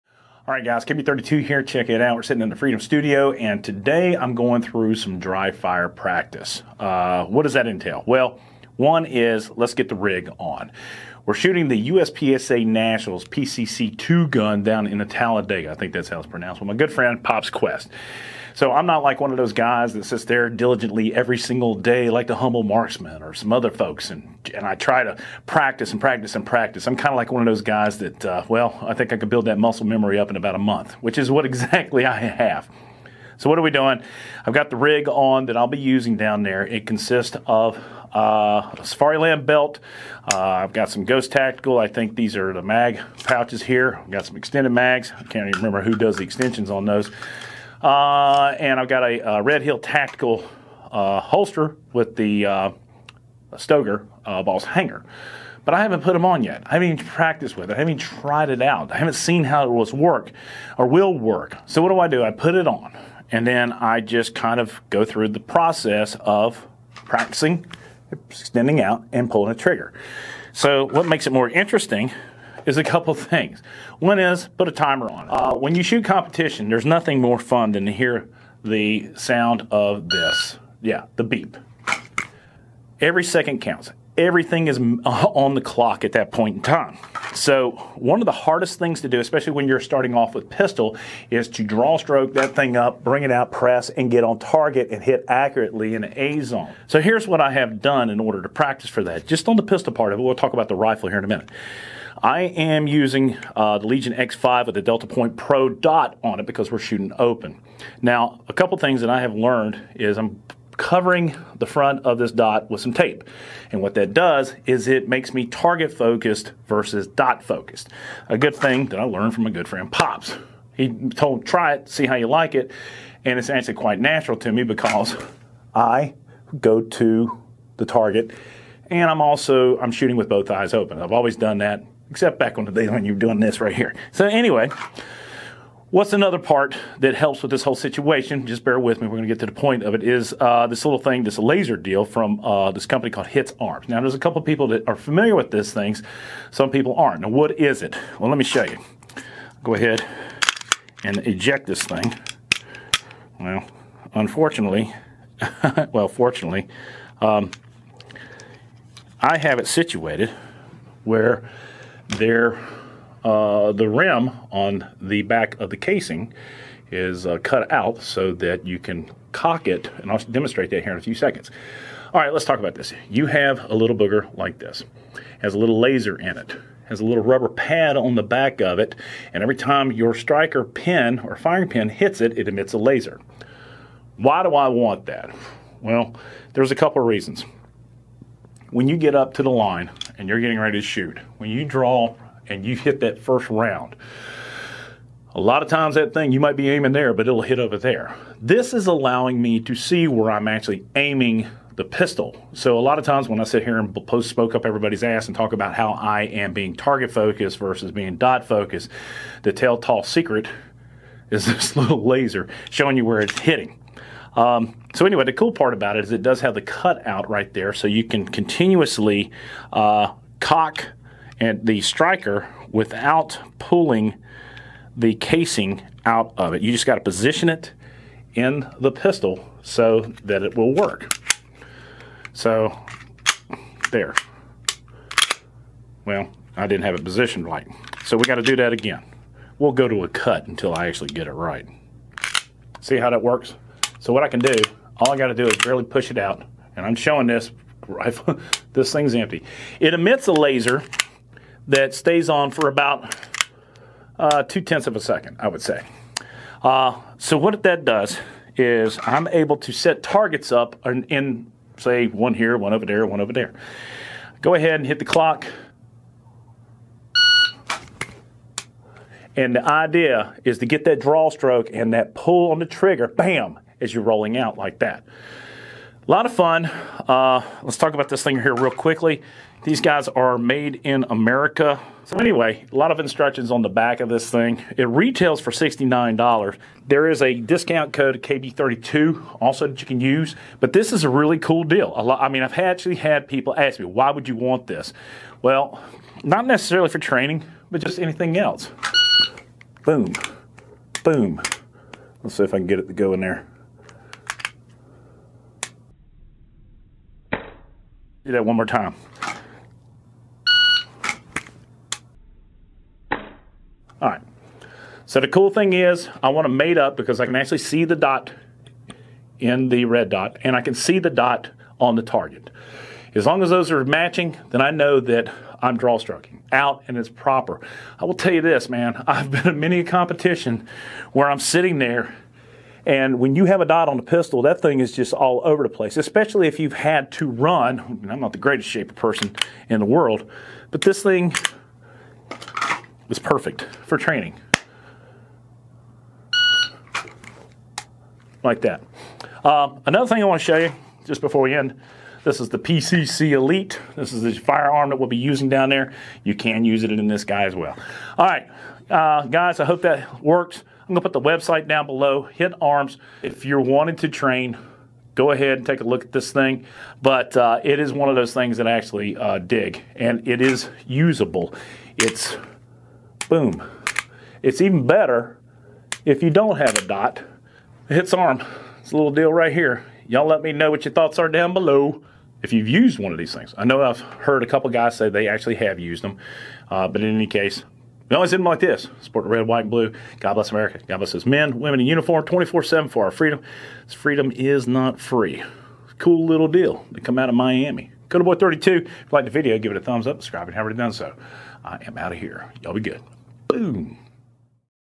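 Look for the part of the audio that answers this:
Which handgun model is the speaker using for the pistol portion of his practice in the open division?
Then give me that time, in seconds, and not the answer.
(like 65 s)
103 s.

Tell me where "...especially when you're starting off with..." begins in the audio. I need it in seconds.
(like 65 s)
89 s.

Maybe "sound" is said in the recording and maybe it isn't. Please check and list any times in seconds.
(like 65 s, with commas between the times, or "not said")
79 s.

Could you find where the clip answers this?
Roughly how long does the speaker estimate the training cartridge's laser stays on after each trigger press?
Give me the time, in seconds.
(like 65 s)
254 s.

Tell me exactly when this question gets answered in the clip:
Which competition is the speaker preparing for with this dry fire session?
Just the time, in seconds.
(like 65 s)
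11 s.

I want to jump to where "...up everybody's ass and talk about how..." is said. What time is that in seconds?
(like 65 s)
204 s.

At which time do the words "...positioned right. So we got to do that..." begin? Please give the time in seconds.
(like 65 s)
237 s.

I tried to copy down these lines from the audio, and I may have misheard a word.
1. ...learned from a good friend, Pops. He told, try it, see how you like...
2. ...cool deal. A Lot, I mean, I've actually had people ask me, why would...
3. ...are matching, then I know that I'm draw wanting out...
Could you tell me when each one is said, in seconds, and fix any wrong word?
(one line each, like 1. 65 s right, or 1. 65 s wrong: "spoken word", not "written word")
1. 119 s right
2. 291 s right
3. 323 s wrong: "stroking", not "wanting".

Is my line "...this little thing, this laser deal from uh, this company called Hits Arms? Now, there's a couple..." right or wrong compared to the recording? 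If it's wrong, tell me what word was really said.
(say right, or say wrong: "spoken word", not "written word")
right.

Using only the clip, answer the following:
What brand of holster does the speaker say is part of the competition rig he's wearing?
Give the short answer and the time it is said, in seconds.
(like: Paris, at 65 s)
Red Hill Tactical, at 49 s.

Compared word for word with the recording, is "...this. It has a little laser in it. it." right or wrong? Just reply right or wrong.
right.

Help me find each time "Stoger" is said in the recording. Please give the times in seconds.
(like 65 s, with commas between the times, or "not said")
53 s.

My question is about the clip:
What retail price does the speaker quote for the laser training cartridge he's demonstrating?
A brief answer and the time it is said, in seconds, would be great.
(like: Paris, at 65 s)
$69, at 285 s.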